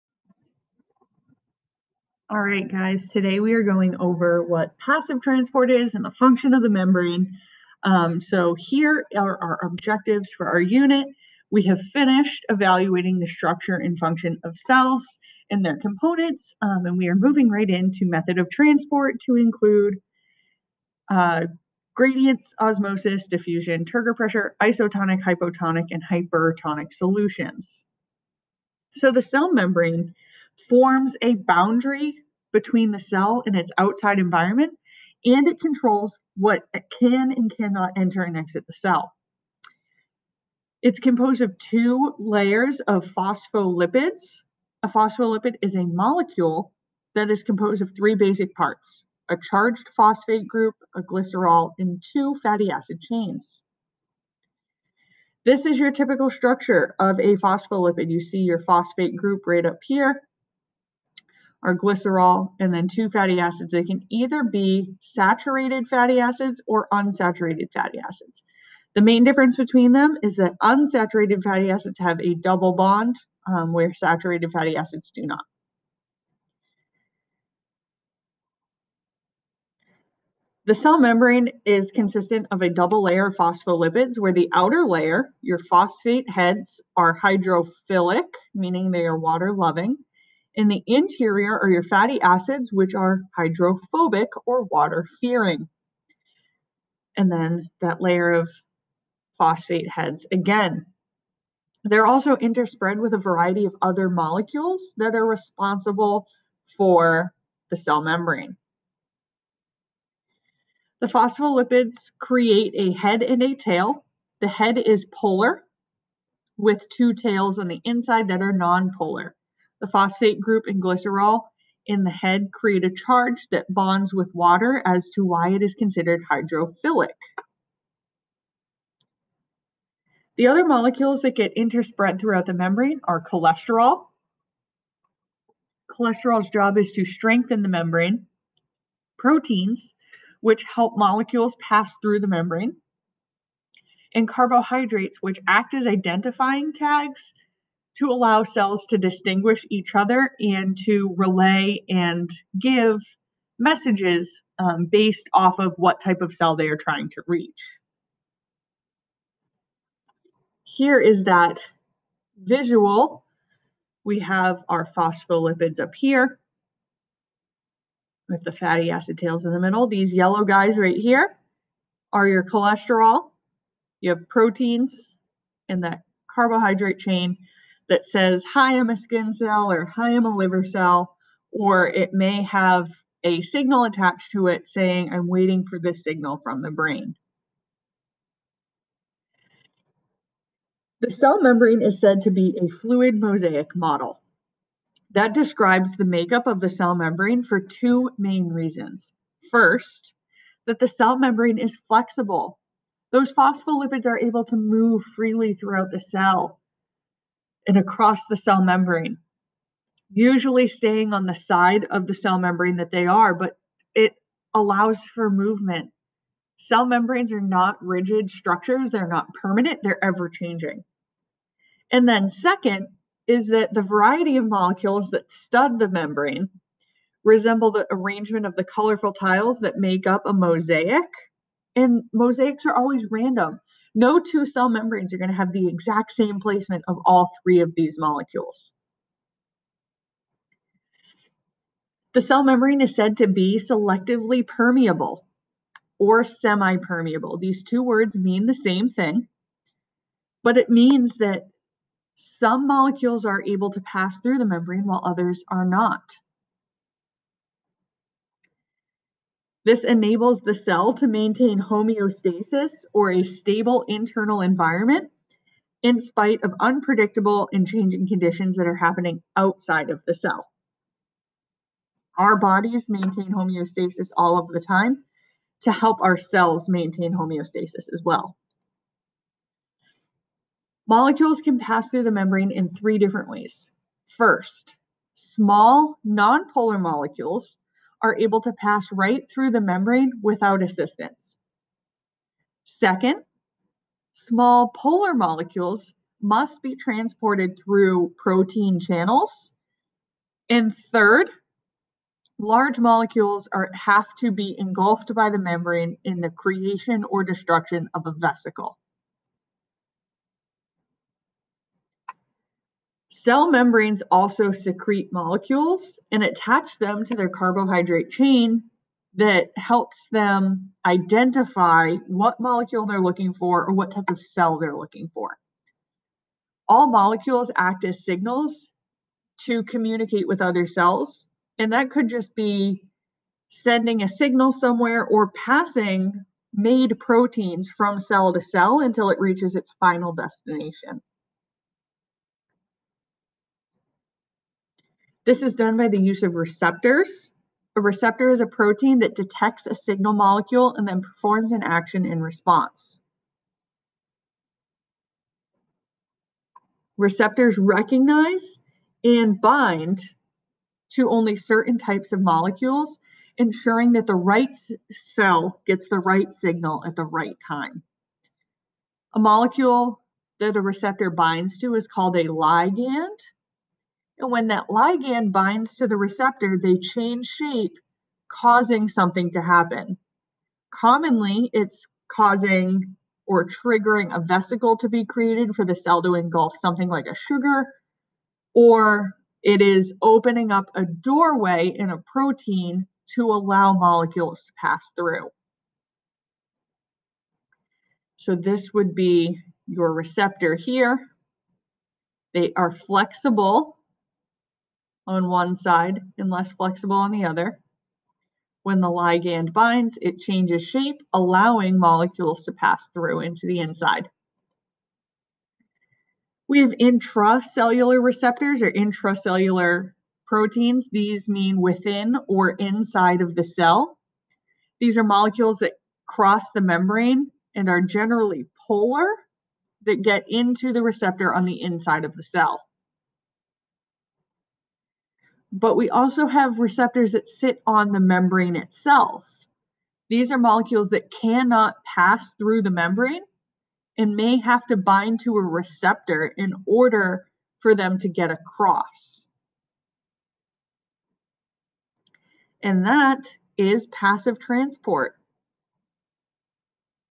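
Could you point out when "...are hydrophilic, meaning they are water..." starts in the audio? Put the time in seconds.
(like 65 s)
86 s.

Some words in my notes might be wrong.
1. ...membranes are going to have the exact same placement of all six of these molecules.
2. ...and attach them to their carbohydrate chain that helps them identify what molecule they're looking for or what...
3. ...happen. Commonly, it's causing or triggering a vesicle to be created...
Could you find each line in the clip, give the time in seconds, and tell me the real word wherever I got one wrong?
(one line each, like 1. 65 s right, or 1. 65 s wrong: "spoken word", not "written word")
1. 234 s wrong: "three", not "six"
2. 316 s right
3. 379 s right.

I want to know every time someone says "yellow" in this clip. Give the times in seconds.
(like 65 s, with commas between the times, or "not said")
170 s.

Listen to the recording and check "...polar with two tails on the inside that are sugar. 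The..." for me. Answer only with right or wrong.
wrong.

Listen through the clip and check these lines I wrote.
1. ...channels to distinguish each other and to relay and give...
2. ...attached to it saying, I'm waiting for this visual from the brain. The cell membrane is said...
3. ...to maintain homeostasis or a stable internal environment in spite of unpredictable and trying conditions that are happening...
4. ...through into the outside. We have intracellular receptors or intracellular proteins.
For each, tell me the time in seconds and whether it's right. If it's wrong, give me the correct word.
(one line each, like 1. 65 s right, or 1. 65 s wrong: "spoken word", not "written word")
1. 148 s wrong: "cells", not "channels"
2. 183 s wrong: "signal", not "visual"
3. 260 s wrong: "changing", not "trying"
4. 412 s wrong: "inside", not "outside".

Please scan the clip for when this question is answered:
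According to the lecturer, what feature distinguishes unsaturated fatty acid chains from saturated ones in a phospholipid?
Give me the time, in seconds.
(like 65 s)
72 s.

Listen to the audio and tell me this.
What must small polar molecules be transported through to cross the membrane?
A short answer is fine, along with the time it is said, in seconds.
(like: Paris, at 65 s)
protein channels, at 298 s.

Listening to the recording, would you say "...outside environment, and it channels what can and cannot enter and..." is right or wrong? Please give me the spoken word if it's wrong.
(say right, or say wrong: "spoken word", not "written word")
wrong: "controls", not "channels".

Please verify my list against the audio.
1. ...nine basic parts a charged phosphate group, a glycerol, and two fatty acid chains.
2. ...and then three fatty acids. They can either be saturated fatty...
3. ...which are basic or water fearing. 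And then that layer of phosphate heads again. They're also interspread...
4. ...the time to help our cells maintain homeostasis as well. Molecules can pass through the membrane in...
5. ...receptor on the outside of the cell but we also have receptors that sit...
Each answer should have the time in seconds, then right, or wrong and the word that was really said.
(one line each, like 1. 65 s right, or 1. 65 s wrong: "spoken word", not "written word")
1. 47 s wrong: "three", not "nine"
2. 62 s wrong: "two", not "three"
3. 92 s wrong: "hydrophobic", not "basic"
4. 274 s right
5. 430 s wrong: "inside", not "outside".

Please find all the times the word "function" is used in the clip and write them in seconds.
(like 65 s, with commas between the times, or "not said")
6 s, 13 s.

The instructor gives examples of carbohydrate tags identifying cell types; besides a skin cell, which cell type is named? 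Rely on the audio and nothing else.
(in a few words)
liver cell.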